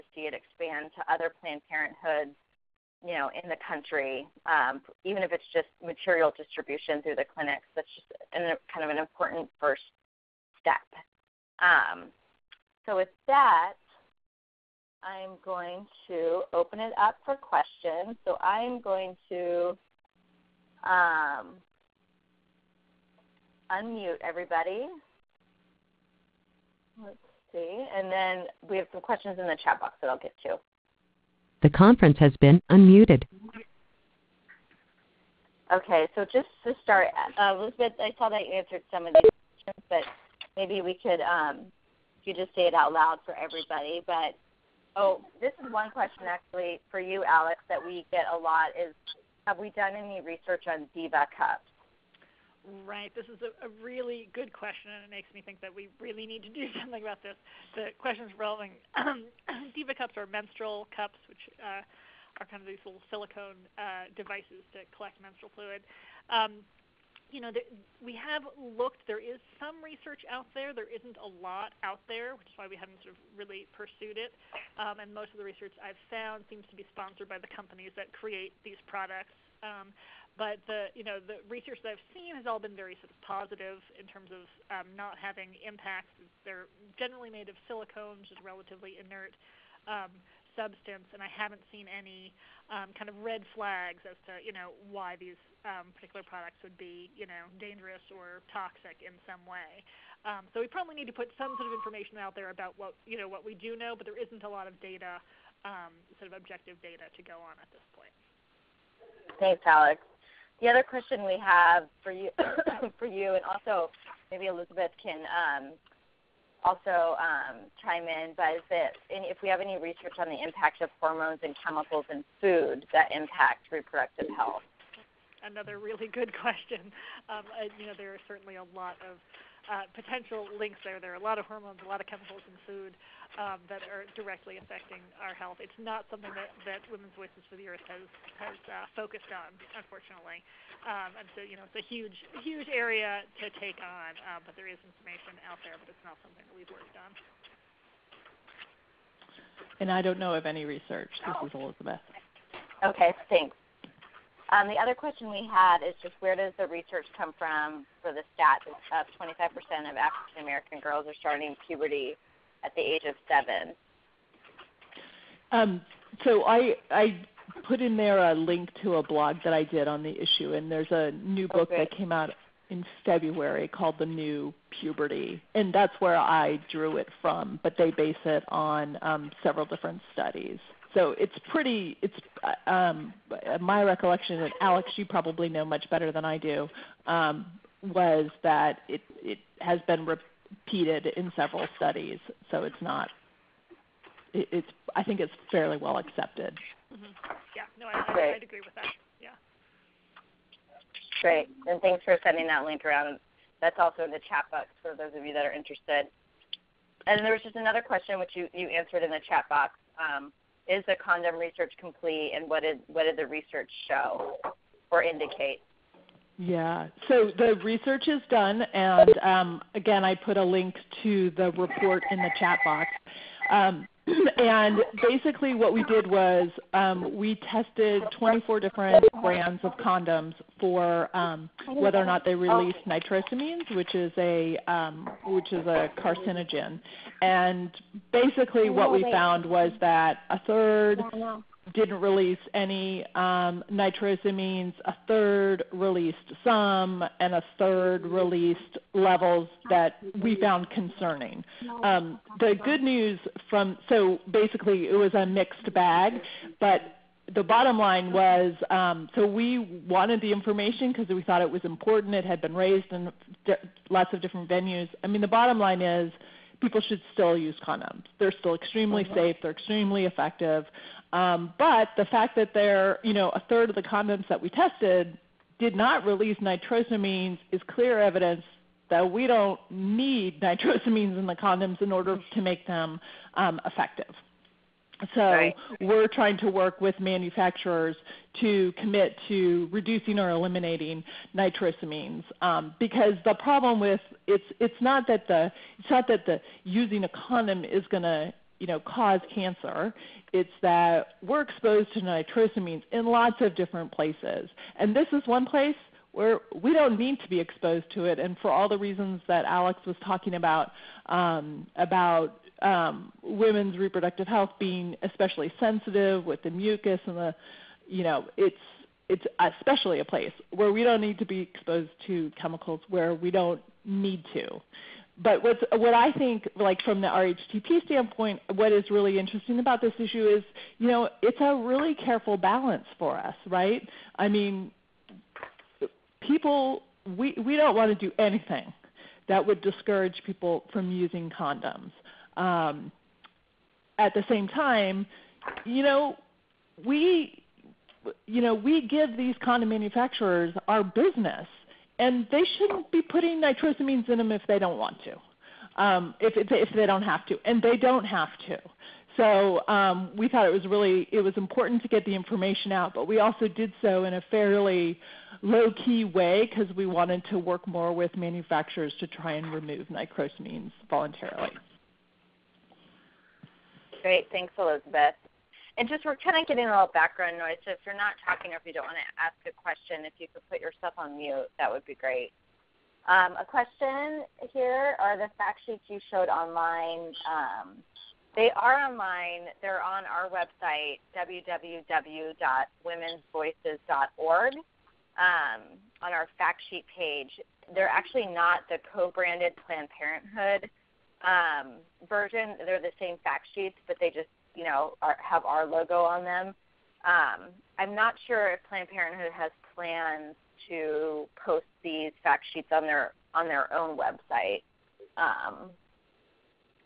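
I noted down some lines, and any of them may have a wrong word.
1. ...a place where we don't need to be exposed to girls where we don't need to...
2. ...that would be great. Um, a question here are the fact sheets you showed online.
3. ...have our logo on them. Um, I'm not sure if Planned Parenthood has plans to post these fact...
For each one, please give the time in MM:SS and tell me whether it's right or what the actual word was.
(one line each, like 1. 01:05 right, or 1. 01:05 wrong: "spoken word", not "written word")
1. 05:20 wrong: "chemicals", not "girls"
2. 06:21 right
3. 06:45 right.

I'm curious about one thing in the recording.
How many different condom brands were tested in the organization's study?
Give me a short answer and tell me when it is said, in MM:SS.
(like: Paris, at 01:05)
24, at 03:48.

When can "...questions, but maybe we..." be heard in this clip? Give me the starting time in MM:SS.
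00:39.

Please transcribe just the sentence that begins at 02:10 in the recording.
There are a lot of hormones, a lot of chemicals in food um, that are directly affecting our health.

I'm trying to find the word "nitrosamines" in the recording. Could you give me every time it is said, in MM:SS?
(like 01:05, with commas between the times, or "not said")
03:52, 04:03, 04:36, 04:40, 04:51, 05:02, 05:53, 06:09.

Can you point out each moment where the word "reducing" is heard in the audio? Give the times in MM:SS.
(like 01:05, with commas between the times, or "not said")
04:49.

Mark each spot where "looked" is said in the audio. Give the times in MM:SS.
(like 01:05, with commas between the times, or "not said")
01:08.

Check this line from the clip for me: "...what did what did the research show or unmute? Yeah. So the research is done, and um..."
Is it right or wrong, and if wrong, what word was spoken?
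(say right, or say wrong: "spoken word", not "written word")
wrong: "indicate", not "unmute".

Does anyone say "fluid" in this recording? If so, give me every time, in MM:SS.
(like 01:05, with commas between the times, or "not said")
01:05.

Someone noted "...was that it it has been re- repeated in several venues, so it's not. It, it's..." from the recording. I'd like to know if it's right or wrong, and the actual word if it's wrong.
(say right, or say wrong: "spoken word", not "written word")
wrong: "studies", not "venues".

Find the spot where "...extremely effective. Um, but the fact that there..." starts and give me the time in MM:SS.
04:29.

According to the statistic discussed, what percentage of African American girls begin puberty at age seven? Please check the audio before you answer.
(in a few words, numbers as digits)
25%.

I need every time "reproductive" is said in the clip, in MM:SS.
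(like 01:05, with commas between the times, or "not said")
02:03, 05:13.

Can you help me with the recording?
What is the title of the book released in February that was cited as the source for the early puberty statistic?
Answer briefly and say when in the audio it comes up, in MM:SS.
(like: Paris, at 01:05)
The New Puberty, at 02:53.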